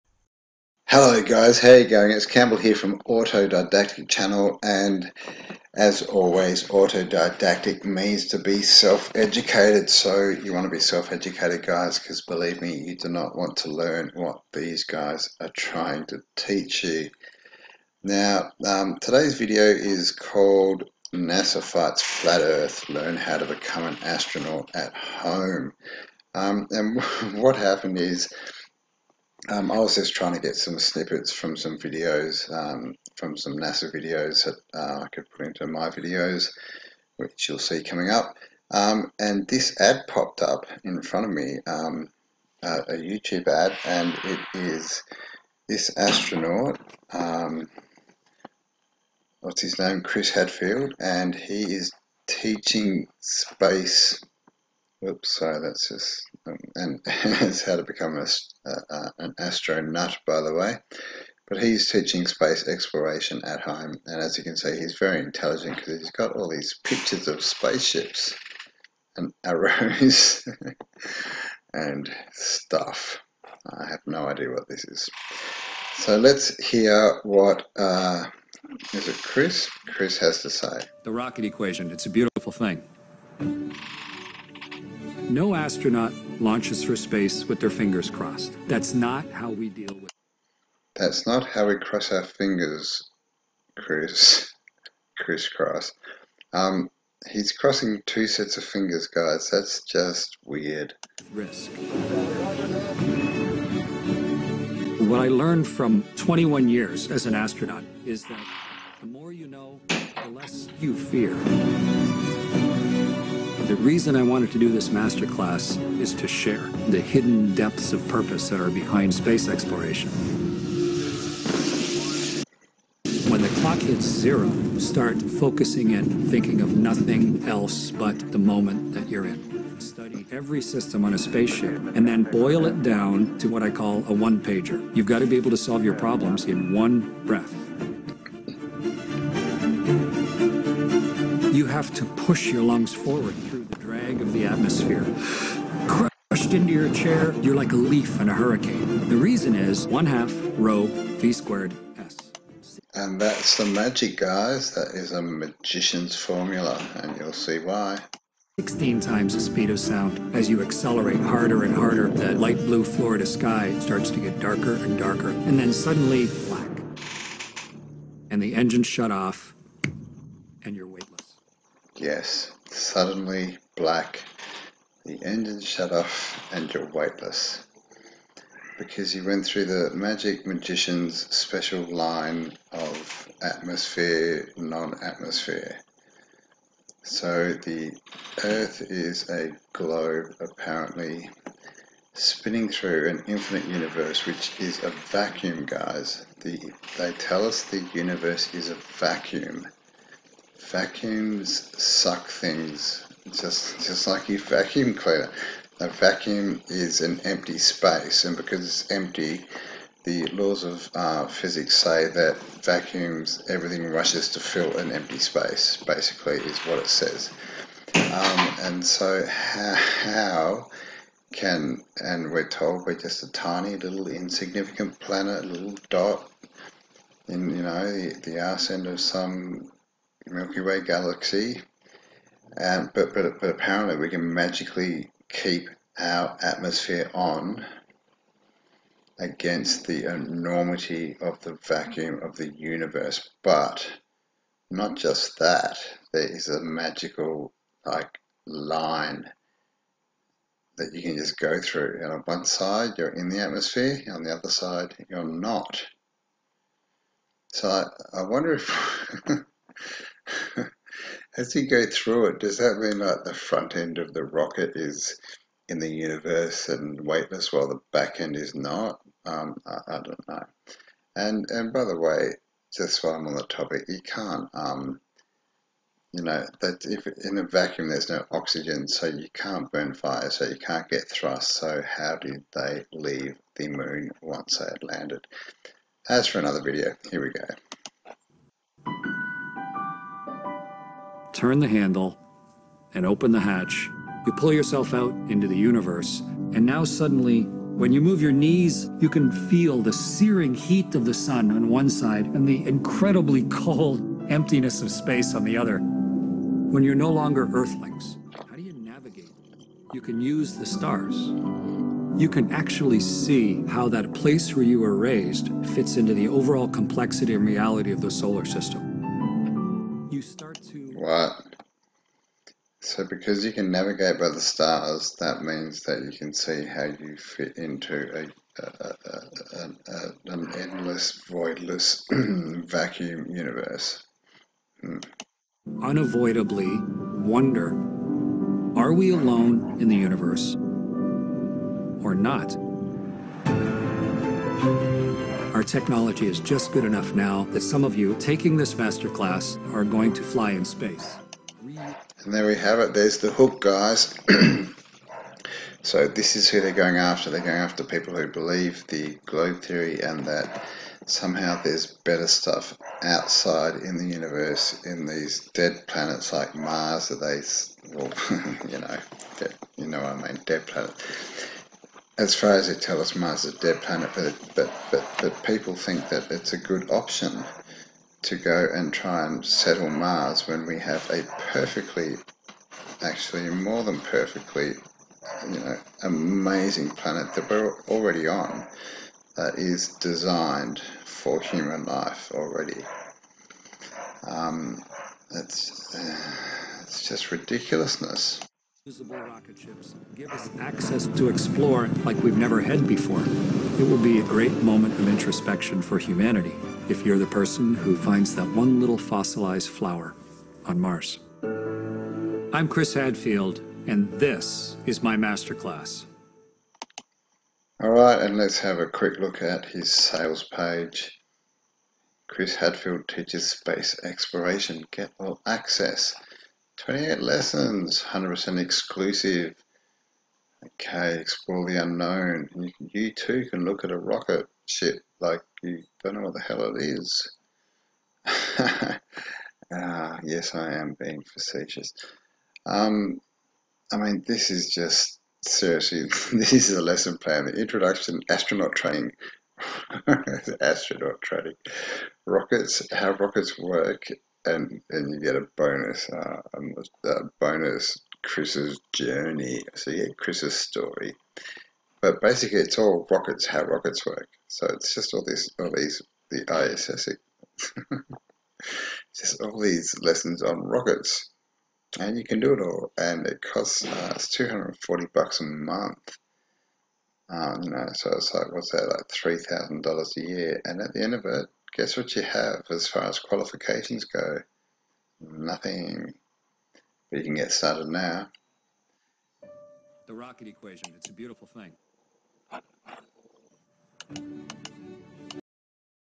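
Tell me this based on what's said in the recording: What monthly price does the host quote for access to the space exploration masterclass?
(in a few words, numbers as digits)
$240.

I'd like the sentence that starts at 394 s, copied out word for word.
Um, it's, uh, it's just ridiculousness visible rocket ships give us access to explore like we've never had before.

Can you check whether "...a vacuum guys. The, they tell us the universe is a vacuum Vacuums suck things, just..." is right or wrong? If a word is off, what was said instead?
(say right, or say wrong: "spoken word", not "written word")
right.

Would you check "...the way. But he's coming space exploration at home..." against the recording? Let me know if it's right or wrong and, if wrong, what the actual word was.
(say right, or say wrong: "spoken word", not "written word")
wrong: "teaching", not "coming".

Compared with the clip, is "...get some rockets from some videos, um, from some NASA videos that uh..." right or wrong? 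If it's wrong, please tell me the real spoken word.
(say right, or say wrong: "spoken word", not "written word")
wrong: "snippets", not "rockets".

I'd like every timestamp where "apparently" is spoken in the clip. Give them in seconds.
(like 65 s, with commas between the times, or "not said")
190 s, 233 s.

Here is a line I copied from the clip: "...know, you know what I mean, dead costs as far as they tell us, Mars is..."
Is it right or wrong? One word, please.
wrong.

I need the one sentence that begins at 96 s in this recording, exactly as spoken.
Um, he's crossing two sets of fingers, guys.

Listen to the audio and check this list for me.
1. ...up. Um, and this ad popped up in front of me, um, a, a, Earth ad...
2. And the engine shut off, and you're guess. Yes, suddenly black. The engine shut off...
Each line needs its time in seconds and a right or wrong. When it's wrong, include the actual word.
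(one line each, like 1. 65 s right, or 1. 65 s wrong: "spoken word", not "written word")
1. 38 s wrong: "YouTube", not "Earth"
2. 168 s wrong: "weightless", not "guess".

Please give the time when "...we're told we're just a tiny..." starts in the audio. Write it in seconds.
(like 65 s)
222 s.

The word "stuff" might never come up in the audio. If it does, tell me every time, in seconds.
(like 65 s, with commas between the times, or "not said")
72 s, 362 s.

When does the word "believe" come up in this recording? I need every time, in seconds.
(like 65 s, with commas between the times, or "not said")
12 s, 358 s.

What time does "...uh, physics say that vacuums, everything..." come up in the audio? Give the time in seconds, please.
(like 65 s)
210 s.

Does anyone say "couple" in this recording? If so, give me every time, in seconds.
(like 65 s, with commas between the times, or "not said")
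not said.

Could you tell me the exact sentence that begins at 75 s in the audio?
So let's hear what uh, is it Chris?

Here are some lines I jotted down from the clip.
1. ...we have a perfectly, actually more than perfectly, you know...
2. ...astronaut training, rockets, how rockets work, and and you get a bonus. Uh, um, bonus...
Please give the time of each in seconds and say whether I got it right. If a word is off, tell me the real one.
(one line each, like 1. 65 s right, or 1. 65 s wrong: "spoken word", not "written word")
1. 380 s right
2. 450 s right.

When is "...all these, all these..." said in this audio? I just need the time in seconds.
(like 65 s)
465 s.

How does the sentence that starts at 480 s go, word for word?
And at the end of it, guess what you have as far as qualifications go?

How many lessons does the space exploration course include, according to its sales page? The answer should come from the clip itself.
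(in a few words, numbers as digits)
28.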